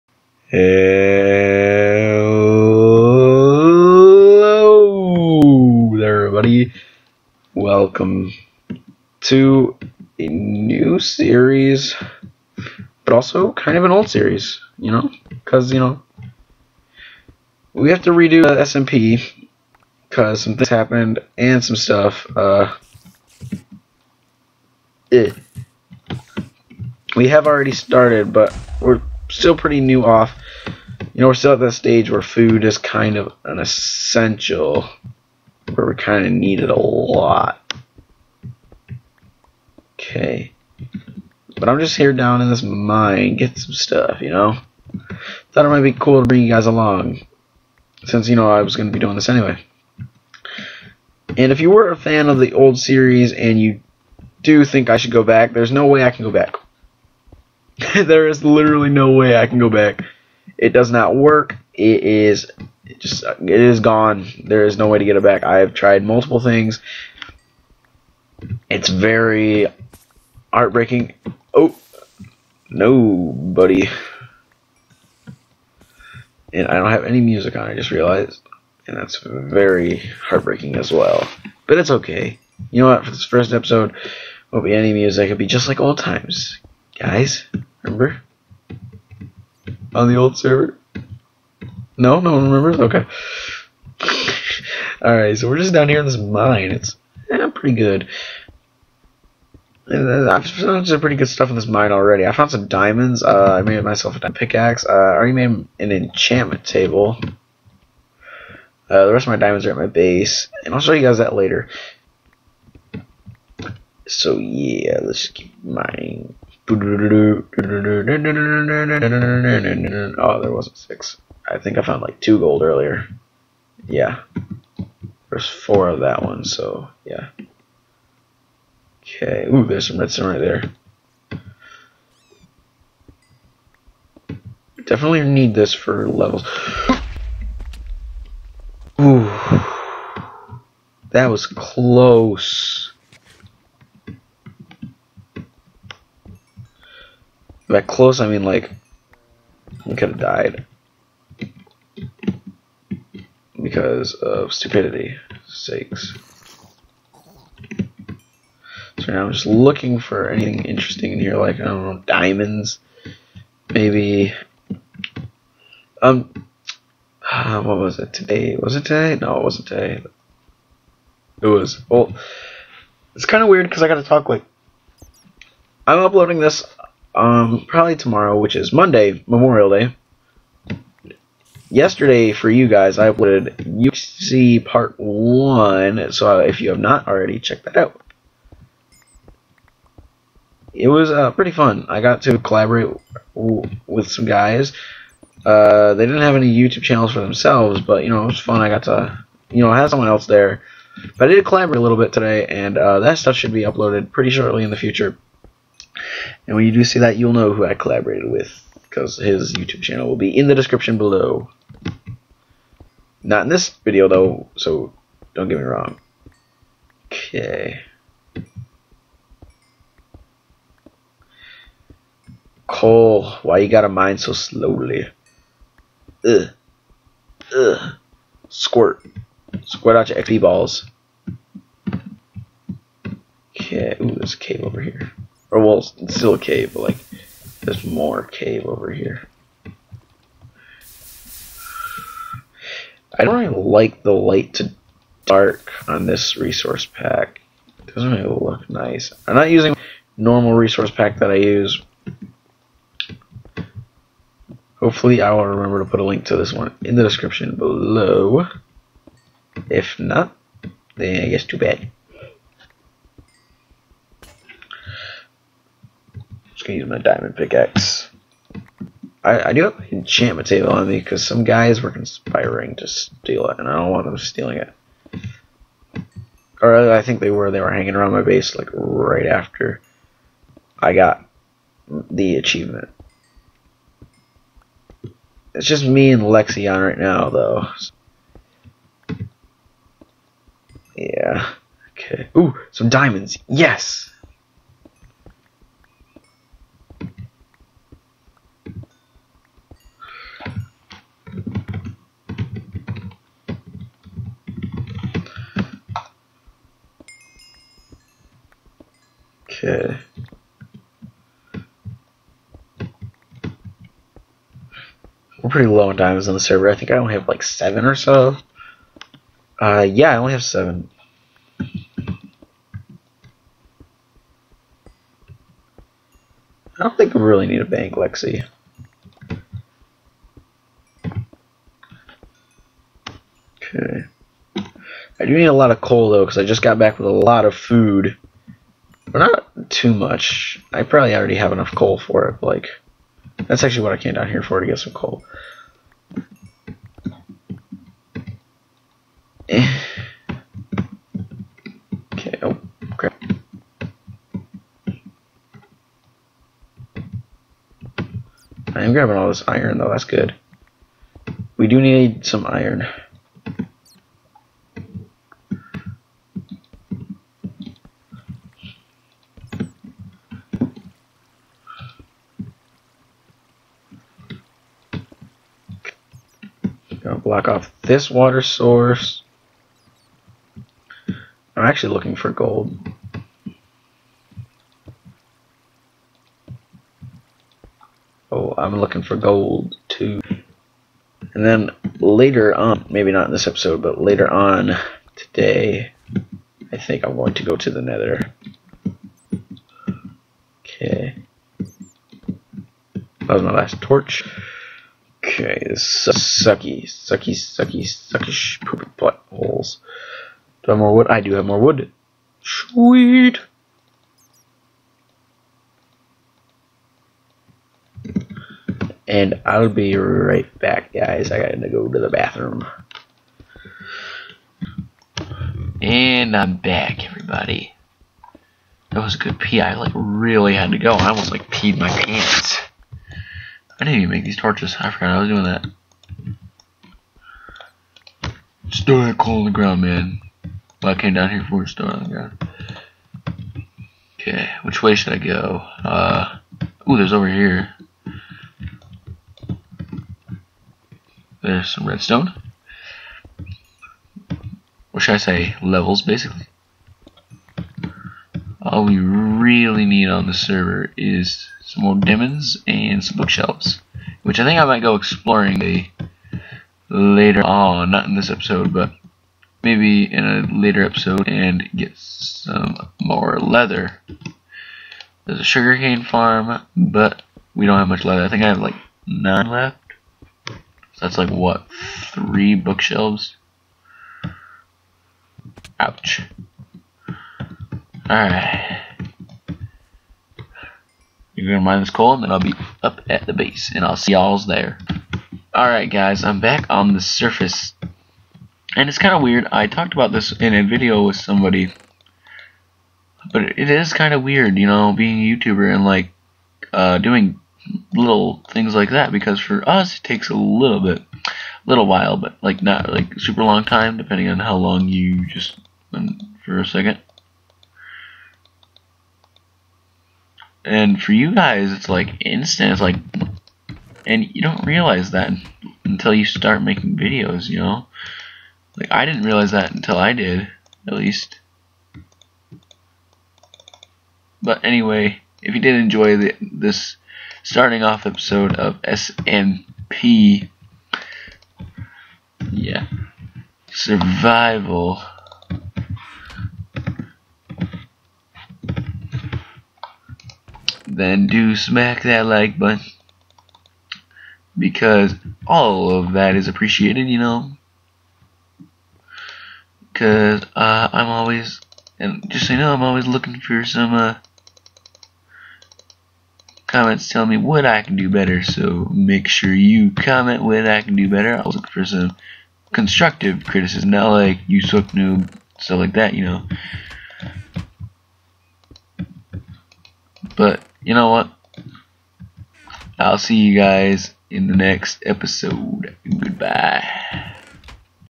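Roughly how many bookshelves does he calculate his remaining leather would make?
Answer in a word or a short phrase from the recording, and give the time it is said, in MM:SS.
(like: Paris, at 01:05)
3, at 08:02.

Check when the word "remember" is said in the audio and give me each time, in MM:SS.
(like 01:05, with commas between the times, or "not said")
01:27, 01:32, 04:15.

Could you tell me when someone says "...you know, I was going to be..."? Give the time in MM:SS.
00:48.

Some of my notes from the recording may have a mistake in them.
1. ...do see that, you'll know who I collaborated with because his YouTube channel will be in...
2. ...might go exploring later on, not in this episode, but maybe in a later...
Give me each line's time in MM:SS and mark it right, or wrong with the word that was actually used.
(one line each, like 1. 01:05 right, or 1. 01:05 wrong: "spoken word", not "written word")
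1. 03:26 right
2. 07:44 right.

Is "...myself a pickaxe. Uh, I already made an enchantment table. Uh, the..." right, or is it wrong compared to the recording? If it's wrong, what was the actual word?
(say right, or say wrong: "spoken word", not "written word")
right.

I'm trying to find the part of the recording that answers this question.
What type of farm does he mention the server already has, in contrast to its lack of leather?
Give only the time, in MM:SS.
07:55.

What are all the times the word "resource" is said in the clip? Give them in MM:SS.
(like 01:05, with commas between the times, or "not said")
04:06, 04:10.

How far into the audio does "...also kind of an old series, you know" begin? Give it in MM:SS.
00:13.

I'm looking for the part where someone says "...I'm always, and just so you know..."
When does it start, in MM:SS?
09:20.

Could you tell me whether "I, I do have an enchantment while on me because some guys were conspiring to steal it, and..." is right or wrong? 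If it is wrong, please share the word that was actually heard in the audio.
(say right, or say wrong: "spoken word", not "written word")
wrong: "table", not "while".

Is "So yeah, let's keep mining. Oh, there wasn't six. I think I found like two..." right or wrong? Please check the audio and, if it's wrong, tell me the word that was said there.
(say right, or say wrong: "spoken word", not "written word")
right.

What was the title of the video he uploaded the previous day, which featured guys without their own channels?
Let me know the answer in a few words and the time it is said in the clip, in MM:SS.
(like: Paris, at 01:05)
UC Part 1, at 03:03.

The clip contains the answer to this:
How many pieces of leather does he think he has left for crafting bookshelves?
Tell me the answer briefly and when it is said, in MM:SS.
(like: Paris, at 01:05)
9, at 07:59.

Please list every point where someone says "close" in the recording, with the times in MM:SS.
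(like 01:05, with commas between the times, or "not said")
02:21, 02:27.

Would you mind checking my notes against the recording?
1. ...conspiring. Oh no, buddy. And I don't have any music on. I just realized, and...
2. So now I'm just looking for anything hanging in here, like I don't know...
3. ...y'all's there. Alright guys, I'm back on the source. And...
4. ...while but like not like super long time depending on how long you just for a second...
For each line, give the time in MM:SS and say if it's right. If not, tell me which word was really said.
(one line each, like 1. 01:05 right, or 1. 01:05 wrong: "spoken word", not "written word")
1. 01:10 wrong: "heartbreaking", not "conspiring"
2. 02:38 wrong: "interesting", not "hanging"
3. 08:14 wrong: "surface", not "source"
4. 08:31 right.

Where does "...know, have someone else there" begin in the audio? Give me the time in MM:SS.
03:19.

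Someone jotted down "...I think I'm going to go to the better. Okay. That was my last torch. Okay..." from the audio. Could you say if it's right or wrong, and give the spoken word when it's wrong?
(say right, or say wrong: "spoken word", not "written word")
wrong: "nether", not "better".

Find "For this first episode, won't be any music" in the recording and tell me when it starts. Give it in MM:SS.
01:23.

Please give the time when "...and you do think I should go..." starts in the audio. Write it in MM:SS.
00:53.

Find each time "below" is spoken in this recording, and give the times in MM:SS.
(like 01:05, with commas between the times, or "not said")
03:30, 04:17.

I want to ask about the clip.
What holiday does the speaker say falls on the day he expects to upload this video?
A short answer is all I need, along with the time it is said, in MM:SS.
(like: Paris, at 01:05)
Memorial Day, at 02:59.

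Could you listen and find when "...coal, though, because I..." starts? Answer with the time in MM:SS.
05:35.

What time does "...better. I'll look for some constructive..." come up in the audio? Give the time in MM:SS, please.
09:31.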